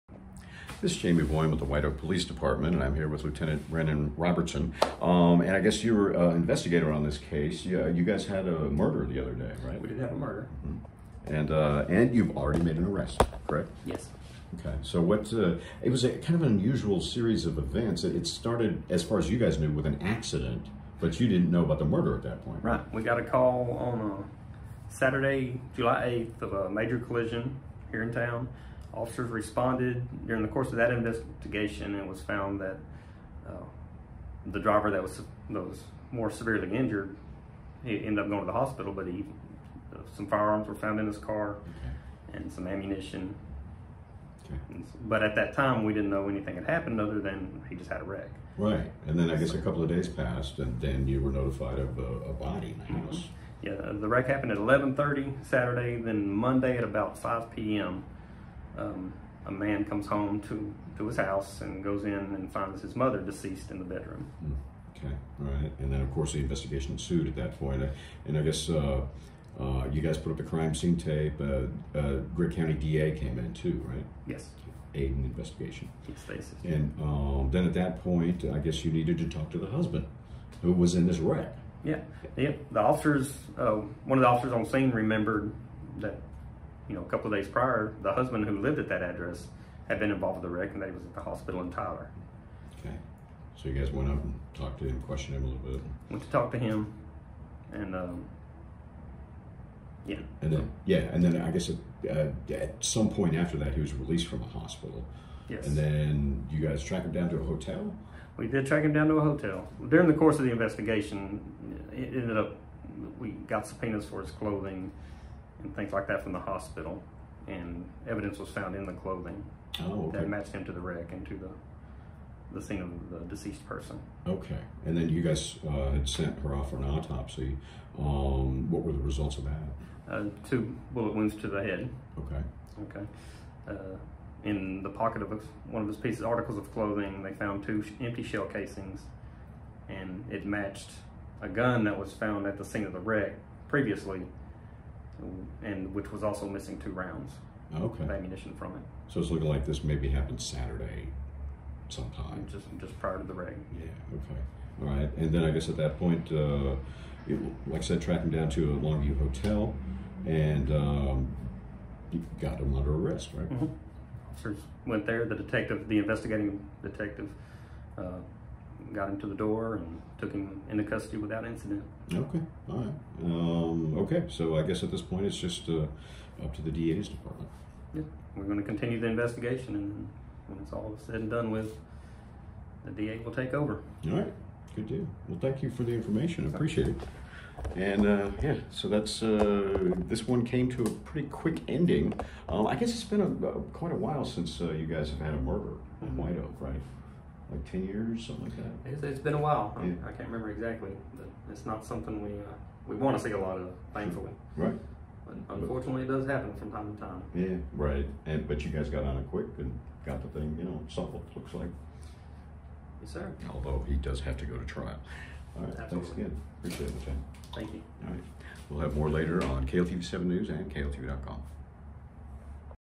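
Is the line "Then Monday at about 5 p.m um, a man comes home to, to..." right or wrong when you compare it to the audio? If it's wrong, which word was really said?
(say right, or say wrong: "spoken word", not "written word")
right.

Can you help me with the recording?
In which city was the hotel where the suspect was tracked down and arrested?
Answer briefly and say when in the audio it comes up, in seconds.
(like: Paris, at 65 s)
Longview, at 158 s.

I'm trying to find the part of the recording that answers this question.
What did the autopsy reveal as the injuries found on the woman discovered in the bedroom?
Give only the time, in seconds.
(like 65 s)
130 s.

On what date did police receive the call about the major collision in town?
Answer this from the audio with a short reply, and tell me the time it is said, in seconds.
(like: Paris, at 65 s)
July 8, at 25 s.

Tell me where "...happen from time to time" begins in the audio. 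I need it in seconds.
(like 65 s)
206 s.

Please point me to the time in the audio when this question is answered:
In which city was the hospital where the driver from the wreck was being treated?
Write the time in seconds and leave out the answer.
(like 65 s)
91 s.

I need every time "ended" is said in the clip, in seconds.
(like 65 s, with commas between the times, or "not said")
38 s, 112 s.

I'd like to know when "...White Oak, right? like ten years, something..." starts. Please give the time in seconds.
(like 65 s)
196 s.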